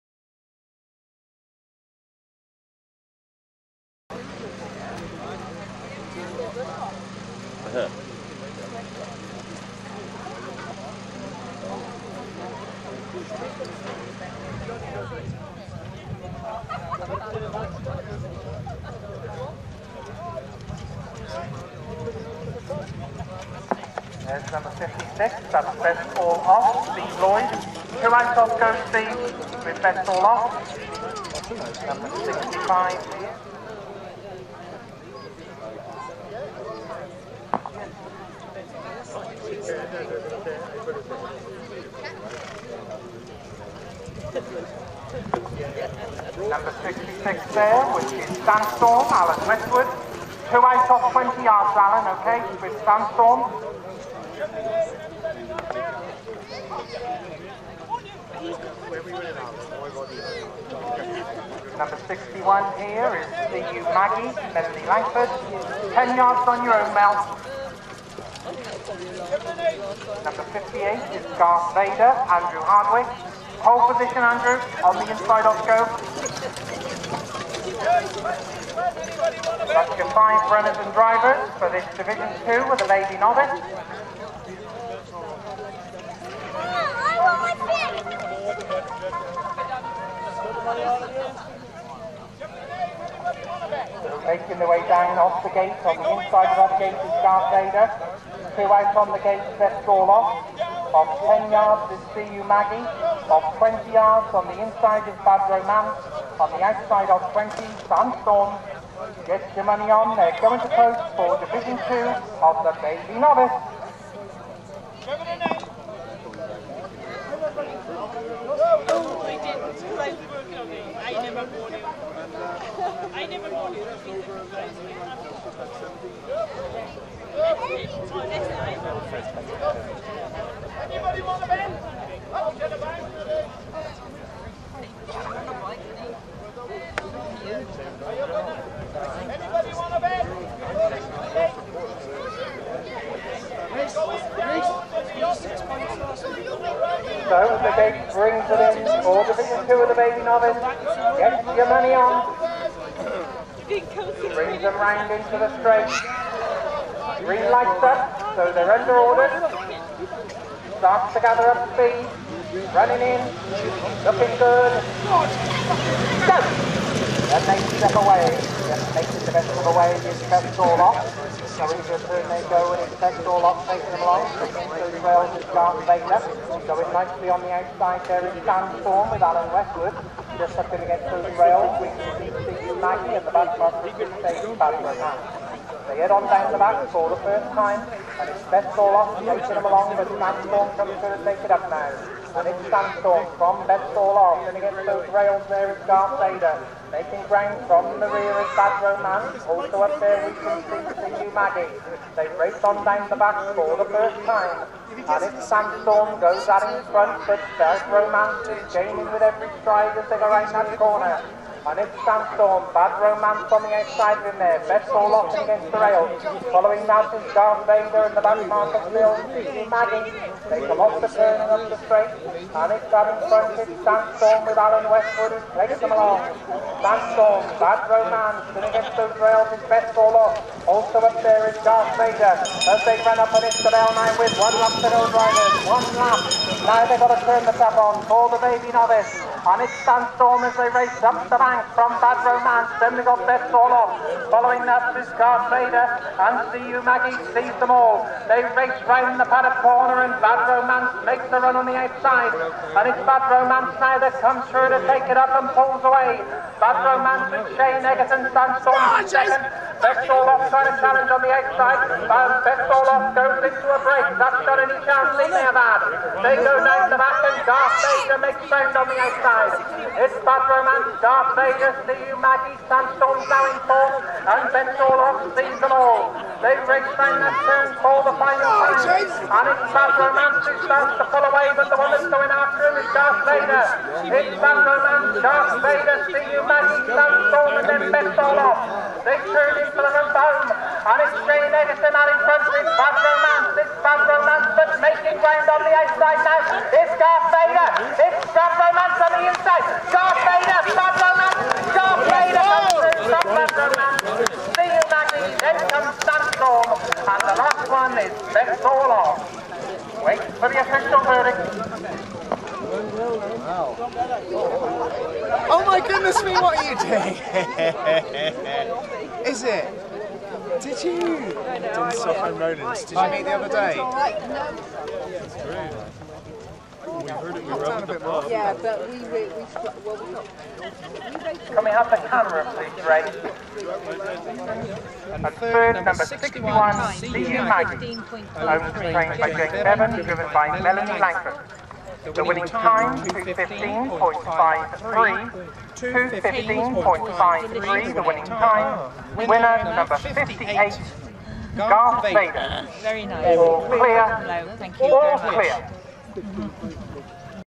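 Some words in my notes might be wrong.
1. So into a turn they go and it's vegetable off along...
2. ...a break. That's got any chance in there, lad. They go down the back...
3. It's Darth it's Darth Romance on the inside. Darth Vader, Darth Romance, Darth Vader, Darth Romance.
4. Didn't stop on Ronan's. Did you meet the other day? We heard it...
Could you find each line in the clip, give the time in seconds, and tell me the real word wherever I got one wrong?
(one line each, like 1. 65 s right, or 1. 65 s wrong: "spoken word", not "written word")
1. 171 s wrong: "taking", not "along"
2. 263 s right
3. 296 s right
4. 321 s right.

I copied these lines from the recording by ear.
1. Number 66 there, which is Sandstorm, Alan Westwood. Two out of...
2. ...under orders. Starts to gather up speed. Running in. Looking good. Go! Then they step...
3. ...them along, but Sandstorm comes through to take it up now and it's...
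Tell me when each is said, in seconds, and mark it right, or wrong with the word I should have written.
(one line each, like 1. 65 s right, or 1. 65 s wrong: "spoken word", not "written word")
1. 46 s right
2. 158 s right
3. 189 s right.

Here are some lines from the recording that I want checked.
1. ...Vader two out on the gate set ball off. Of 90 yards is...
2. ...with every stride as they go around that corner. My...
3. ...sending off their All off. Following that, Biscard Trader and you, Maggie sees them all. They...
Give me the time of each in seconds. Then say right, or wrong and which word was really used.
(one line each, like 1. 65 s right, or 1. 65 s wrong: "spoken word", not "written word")
1. 97 s wrong: "10", not "90"
2. 209 s right
3. 242 s right.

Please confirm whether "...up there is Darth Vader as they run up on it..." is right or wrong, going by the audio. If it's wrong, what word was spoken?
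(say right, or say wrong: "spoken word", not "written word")
right.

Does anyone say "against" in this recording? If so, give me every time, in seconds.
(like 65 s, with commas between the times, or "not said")
180 s, 194 s, 215 s, 228 s.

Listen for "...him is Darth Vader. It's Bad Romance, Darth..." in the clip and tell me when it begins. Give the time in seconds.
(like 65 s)
282 s.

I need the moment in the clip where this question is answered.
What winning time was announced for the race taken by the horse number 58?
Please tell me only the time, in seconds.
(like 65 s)
345 s.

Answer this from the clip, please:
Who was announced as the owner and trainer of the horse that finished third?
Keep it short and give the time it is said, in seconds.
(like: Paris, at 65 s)
Jake Bevan, at 339 s.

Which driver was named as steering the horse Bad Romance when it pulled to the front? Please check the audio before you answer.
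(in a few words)
Shane Egerton.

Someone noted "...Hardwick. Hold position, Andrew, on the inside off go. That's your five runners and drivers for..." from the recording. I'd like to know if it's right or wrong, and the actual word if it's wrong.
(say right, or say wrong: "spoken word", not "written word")
right.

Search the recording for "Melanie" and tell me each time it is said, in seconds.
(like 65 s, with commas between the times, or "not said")
64 s, 340 s.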